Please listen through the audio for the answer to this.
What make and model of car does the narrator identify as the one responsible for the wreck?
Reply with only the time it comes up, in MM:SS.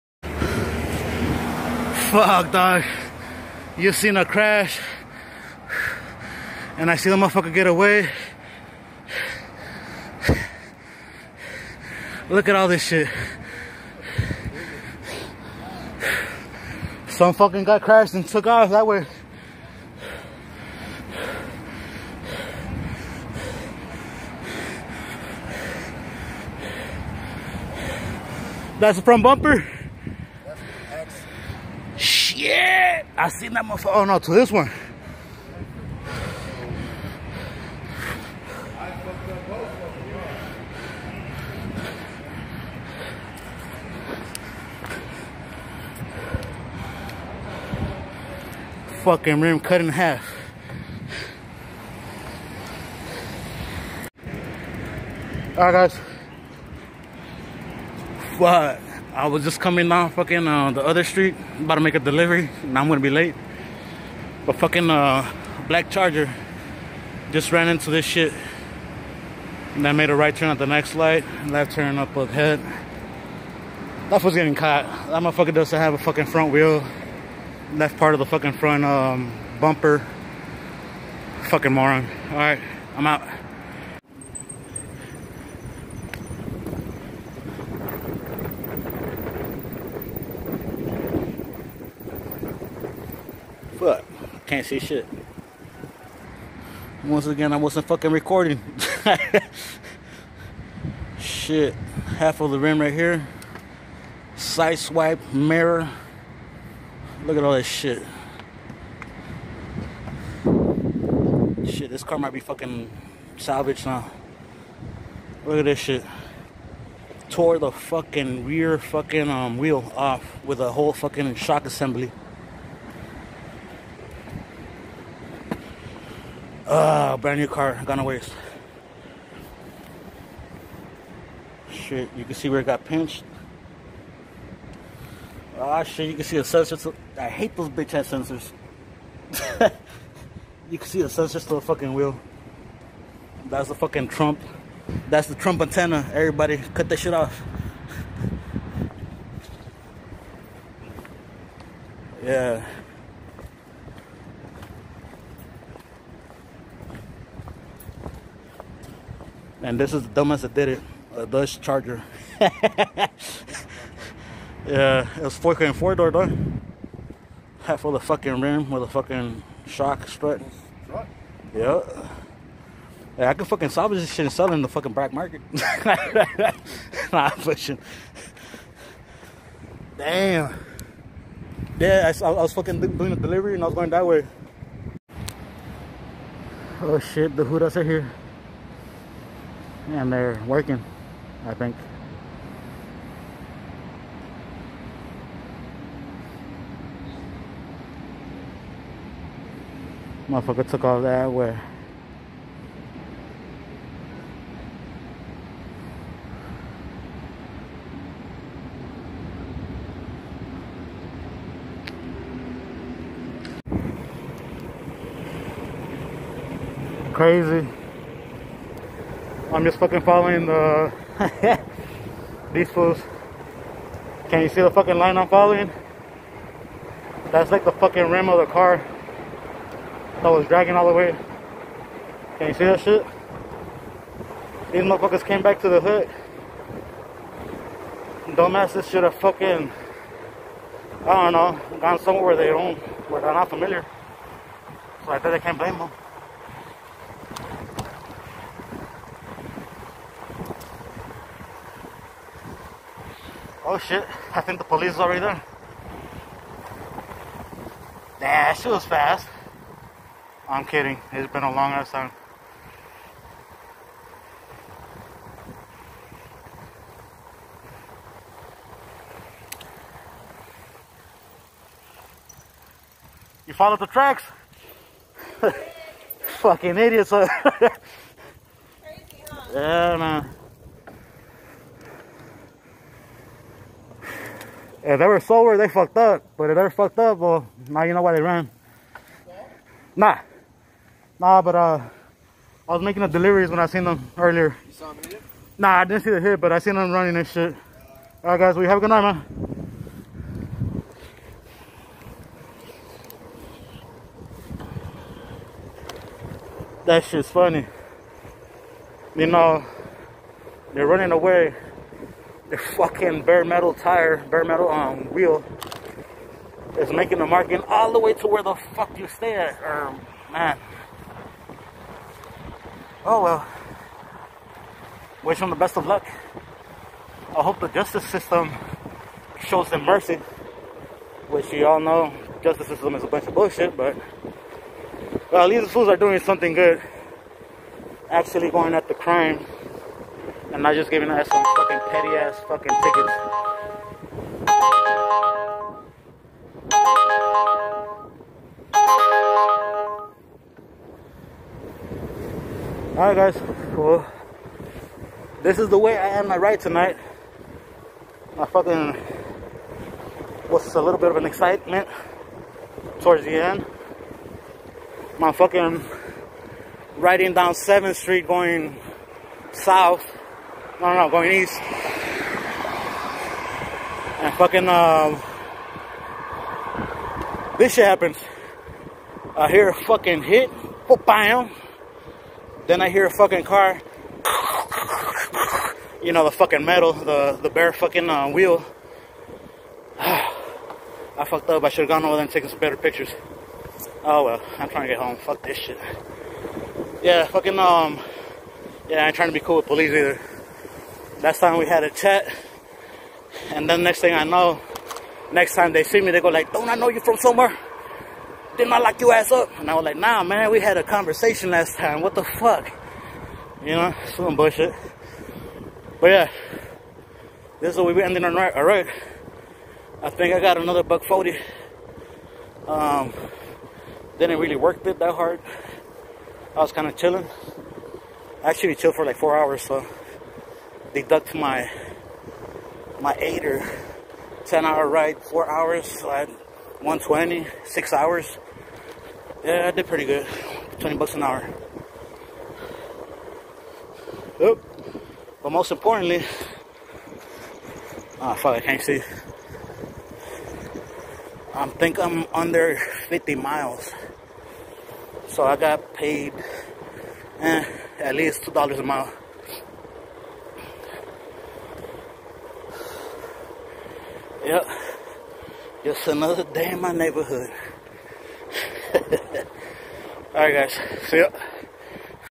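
02:41.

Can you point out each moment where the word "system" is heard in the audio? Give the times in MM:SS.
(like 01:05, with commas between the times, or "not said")
05:28, 05:32.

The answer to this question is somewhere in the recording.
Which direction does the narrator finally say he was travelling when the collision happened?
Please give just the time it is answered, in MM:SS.
06:11.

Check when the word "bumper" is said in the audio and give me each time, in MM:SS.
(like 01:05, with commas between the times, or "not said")
00:29, 01:19.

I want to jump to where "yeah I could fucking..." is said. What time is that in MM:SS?
02:53.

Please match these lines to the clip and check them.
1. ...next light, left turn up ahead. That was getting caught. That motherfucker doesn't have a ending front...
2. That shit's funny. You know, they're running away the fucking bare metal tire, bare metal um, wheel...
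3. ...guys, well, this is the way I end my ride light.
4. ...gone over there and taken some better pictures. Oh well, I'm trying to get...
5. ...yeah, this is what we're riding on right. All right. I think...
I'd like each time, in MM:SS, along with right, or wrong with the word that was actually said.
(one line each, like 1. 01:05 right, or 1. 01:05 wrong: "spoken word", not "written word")
1. 01:10 wrong: "fucking", not "ending"
2. 05:06 right
3. 05:53 wrong: "tonight", not "light"
4. 06:31 right
5. 06:56 wrong: "ending", not "riding".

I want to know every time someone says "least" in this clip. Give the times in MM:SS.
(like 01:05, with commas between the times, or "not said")
05:35, 07:38.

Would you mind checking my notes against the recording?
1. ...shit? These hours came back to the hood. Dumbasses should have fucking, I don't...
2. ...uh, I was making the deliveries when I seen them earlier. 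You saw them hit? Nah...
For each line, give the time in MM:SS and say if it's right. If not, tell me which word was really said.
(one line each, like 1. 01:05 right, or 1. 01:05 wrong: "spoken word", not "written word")
1. 03:52 wrong: "motherfuckers", not "hours"
2. 04:51 right.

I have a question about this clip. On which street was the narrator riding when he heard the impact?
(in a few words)
7th Street.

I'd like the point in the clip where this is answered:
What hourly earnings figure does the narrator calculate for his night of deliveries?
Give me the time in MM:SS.
07:20.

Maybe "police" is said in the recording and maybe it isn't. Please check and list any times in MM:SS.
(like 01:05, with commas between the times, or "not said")
04:14, 06:39.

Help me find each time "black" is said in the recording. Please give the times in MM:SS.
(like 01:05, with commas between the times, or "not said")
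01:05, 02:54.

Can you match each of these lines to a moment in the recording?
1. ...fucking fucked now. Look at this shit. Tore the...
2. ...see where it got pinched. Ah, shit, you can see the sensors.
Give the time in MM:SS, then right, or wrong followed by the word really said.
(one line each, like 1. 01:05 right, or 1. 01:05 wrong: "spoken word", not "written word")
1. 01:52 wrong: "salvaged", not "fucked"
2. 02:12 right.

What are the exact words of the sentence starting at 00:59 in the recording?
I was just coming down fucking uh, the other street, about to make a delivery, and I'm gonna be late.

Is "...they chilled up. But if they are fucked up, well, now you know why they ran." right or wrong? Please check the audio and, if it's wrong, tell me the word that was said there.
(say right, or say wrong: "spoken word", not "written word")
wrong: "fucked", not "chilled".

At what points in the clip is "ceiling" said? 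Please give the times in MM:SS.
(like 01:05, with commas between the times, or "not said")
not said.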